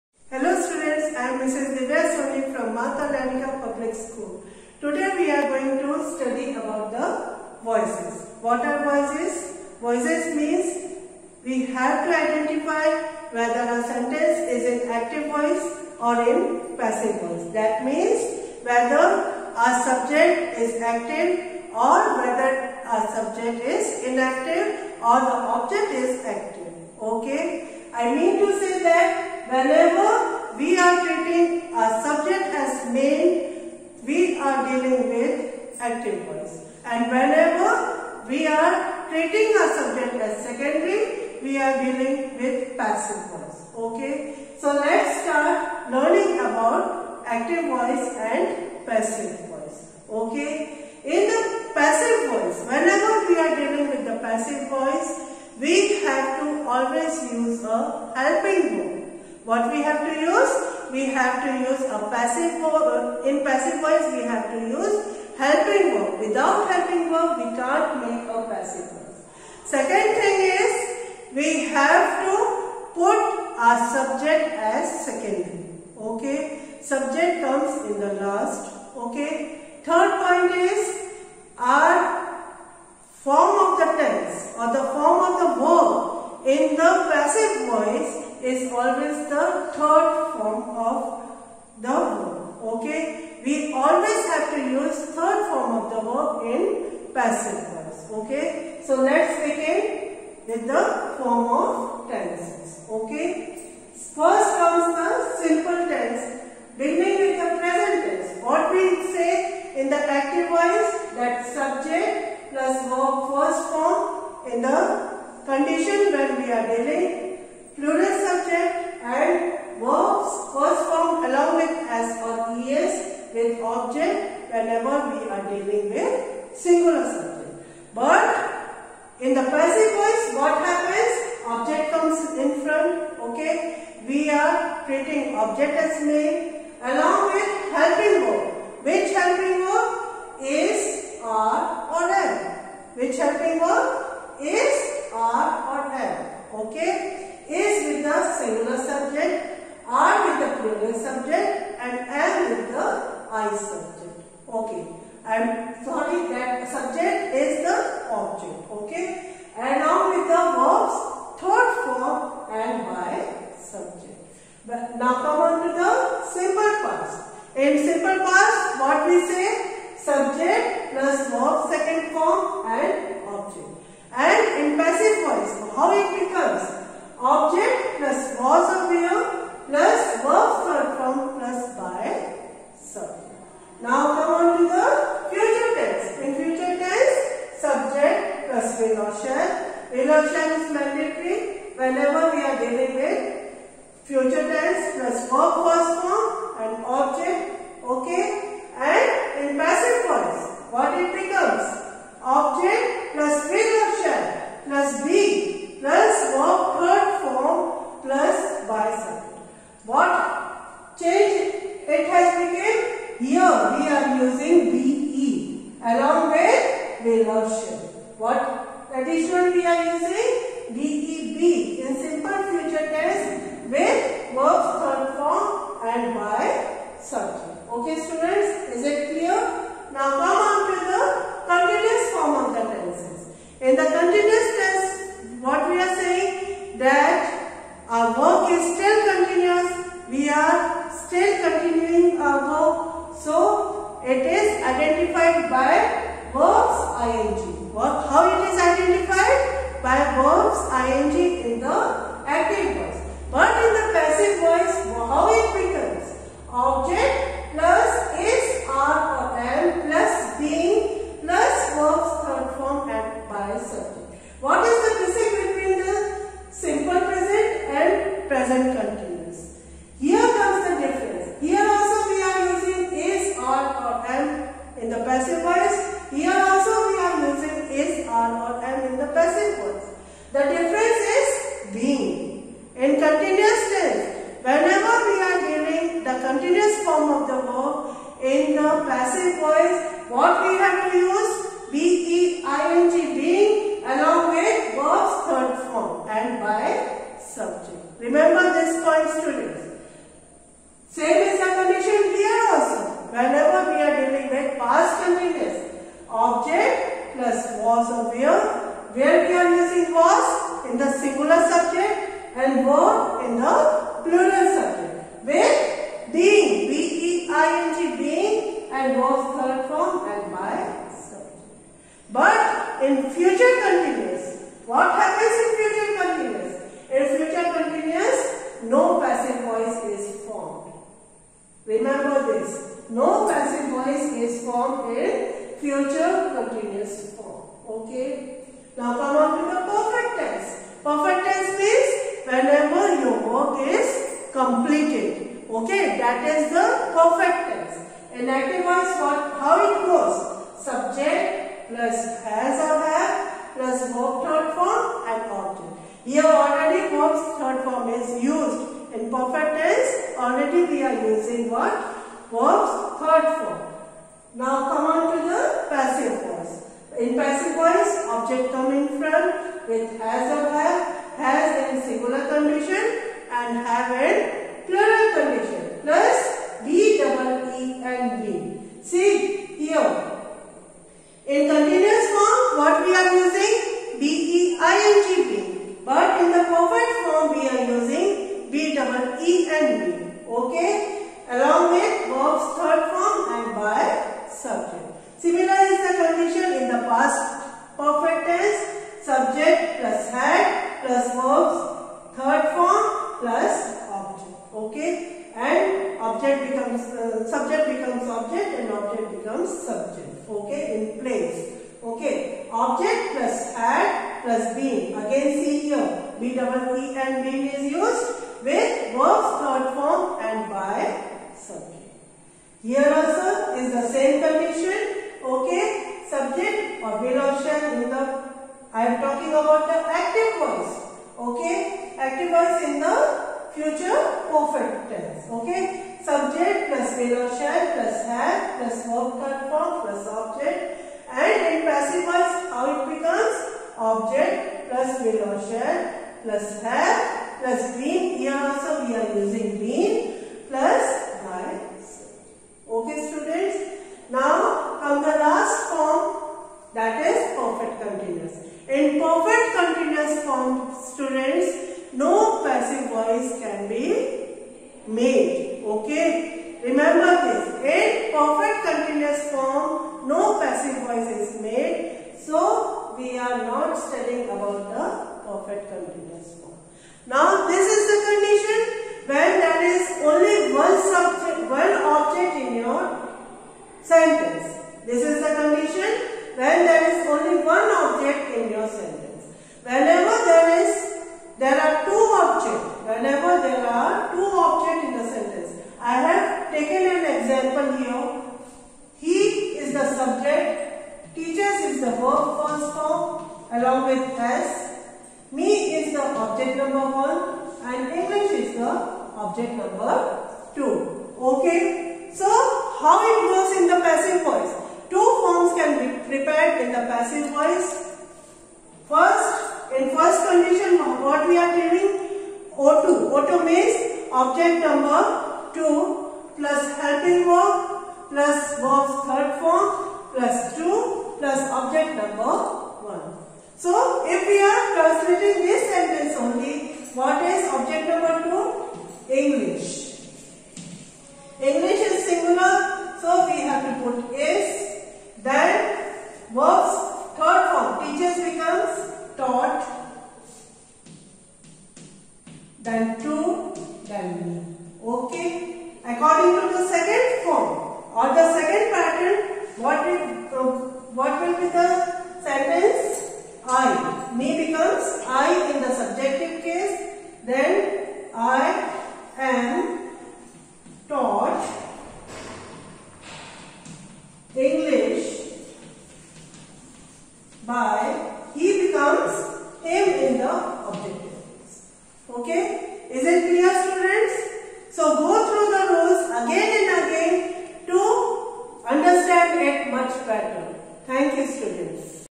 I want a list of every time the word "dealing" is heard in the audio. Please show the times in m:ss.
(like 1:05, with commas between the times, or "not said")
0:34, 0:41, 0:53, 1:56, 2:05.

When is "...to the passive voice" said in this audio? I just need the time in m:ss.
6:05.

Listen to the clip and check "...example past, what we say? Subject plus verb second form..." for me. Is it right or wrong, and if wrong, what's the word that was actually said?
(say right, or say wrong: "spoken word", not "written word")
wrong: "simple", not "example".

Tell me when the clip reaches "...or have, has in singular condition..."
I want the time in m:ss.
6:10.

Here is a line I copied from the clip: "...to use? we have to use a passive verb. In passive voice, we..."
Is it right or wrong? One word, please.
right.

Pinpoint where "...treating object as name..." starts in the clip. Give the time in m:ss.
2:14.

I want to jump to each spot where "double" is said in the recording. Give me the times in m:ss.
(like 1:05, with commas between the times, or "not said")
6:16, 6:56.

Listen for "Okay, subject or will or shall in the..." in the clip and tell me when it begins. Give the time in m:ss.
7:05.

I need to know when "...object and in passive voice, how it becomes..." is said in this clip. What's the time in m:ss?
7:20.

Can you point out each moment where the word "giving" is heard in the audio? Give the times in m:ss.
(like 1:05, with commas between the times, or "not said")
4:45, 8:41.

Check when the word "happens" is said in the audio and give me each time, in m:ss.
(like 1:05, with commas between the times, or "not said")
2:10, 5:24.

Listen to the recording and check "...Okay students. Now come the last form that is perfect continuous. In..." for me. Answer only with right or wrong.
right.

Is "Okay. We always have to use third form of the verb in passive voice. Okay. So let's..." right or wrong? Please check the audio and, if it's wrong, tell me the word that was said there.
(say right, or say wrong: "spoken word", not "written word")
right.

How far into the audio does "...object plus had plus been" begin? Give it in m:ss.
6:52.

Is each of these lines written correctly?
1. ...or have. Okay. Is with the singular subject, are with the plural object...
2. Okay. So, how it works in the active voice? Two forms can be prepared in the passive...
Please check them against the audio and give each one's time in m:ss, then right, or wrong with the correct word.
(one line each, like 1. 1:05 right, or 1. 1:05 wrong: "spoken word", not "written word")
1. 2:25 wrong: "subject", not "object"
2. 8:31 wrong: "passive", not "active".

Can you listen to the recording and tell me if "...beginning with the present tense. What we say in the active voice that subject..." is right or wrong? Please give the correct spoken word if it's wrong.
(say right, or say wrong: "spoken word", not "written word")
right.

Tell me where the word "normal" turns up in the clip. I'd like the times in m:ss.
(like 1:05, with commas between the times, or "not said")
4:38.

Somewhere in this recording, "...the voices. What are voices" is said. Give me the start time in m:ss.
0:06.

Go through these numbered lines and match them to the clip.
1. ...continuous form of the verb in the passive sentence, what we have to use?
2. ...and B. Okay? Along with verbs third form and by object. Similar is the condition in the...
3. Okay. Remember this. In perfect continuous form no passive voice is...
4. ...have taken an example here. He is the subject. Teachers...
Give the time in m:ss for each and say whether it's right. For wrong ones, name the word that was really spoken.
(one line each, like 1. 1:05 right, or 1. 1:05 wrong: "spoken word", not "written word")
1. 4:46 wrong: "voice", not "sentence"
2. 6:29 wrong: "subject", not "object"
3. 7:45 right
4. 8:16 right.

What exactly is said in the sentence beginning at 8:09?
Whenever there is, there are two objects.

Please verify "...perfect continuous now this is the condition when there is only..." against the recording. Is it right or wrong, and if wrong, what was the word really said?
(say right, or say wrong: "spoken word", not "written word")
right.